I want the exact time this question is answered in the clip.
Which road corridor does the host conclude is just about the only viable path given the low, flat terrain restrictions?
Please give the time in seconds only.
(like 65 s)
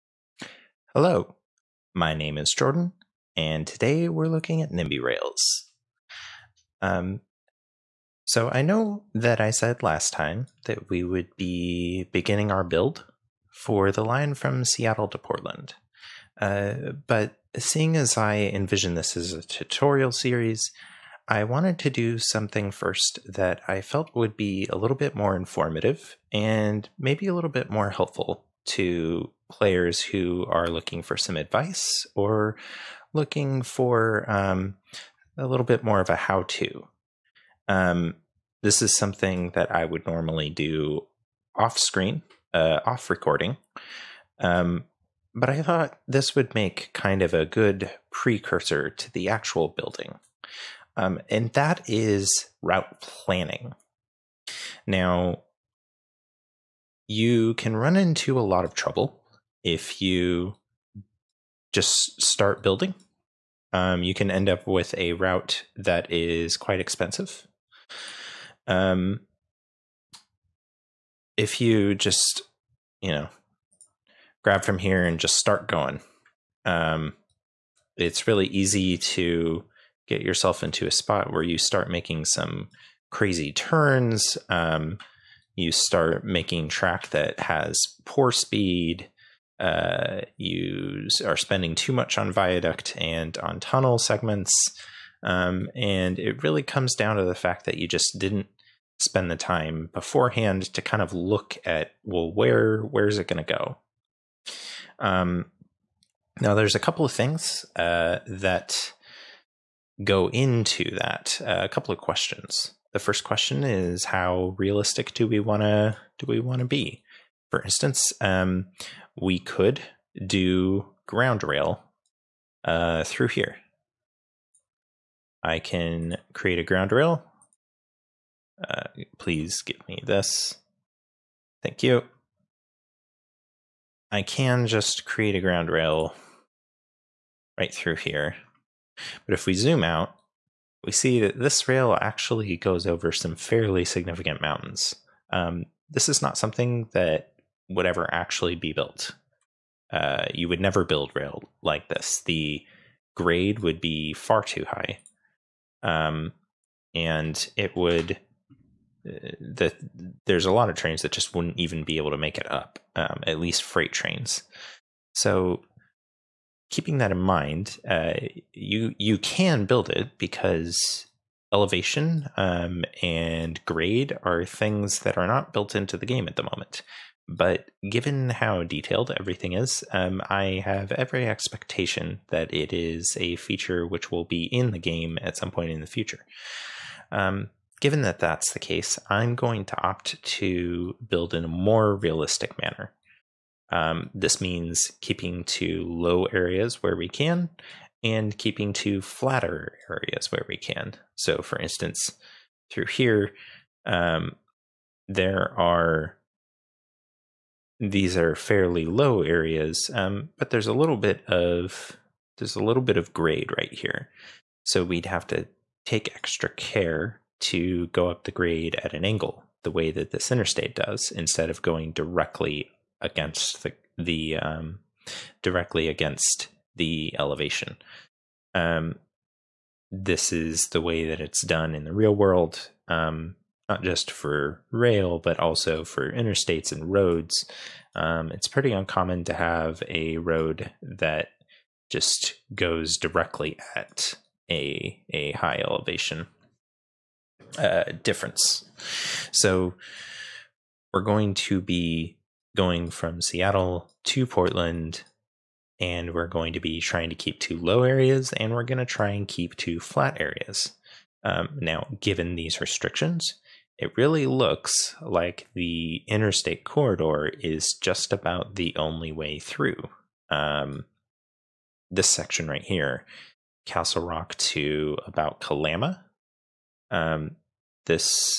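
266 s.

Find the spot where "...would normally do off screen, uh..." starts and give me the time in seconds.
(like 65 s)
39 s.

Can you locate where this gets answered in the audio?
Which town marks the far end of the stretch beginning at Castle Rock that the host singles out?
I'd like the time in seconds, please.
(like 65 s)
275 s.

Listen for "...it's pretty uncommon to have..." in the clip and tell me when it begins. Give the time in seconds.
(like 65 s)
238 s.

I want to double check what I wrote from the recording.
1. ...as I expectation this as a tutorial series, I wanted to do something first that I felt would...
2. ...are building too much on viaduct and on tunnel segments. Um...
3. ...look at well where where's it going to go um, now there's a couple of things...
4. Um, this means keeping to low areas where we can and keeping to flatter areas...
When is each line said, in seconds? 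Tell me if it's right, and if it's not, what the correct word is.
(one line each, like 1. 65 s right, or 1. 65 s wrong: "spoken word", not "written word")
1. 17 s wrong: "envision", not "expectation"
2. 91 s wrong: "spending", not "building"
3. 101 s right
4. 193 s right.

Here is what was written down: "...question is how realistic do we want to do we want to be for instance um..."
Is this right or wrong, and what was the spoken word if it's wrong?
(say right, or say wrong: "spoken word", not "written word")
right.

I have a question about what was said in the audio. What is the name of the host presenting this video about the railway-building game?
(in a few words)
Jordan.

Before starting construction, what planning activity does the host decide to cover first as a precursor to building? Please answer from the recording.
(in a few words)
Route planning.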